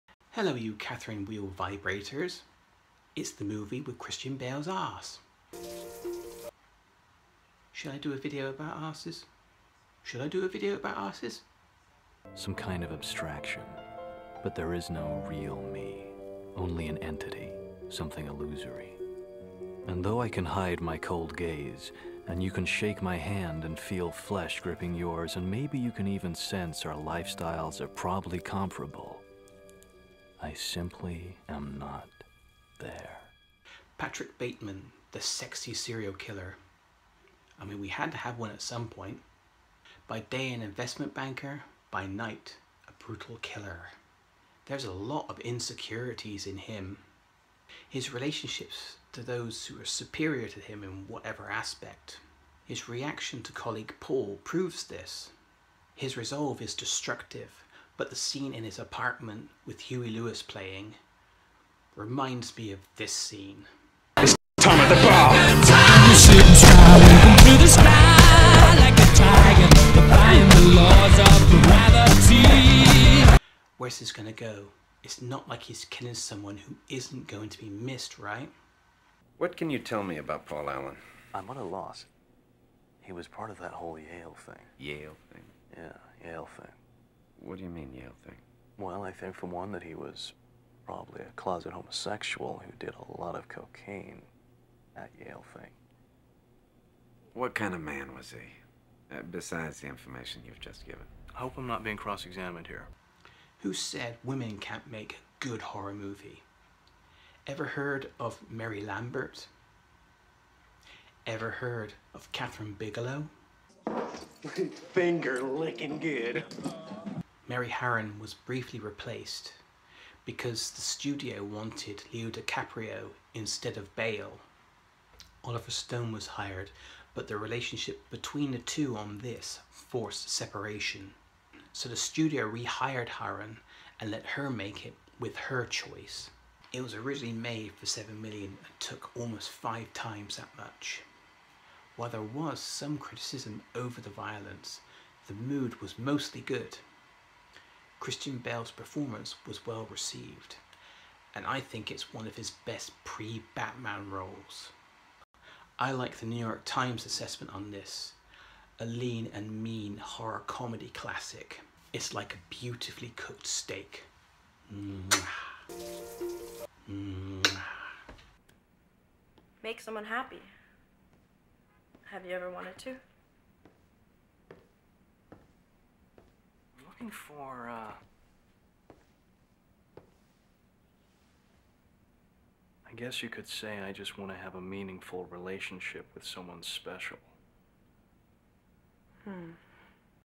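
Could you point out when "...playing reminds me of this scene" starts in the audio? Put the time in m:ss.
1:00.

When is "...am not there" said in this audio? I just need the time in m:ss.
0:31.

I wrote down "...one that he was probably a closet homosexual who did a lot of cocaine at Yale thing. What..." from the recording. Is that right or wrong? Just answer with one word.
right.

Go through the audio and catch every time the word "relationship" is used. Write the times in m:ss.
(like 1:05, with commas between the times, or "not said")
0:48, 2:07, 3:05.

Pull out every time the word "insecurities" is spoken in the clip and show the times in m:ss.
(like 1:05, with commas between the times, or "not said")
0:45.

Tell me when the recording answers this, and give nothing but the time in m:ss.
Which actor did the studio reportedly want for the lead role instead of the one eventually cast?
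2:02.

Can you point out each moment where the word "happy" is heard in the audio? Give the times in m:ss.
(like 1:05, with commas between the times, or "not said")
2:50.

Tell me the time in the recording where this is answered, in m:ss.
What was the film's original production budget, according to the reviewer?
2:17.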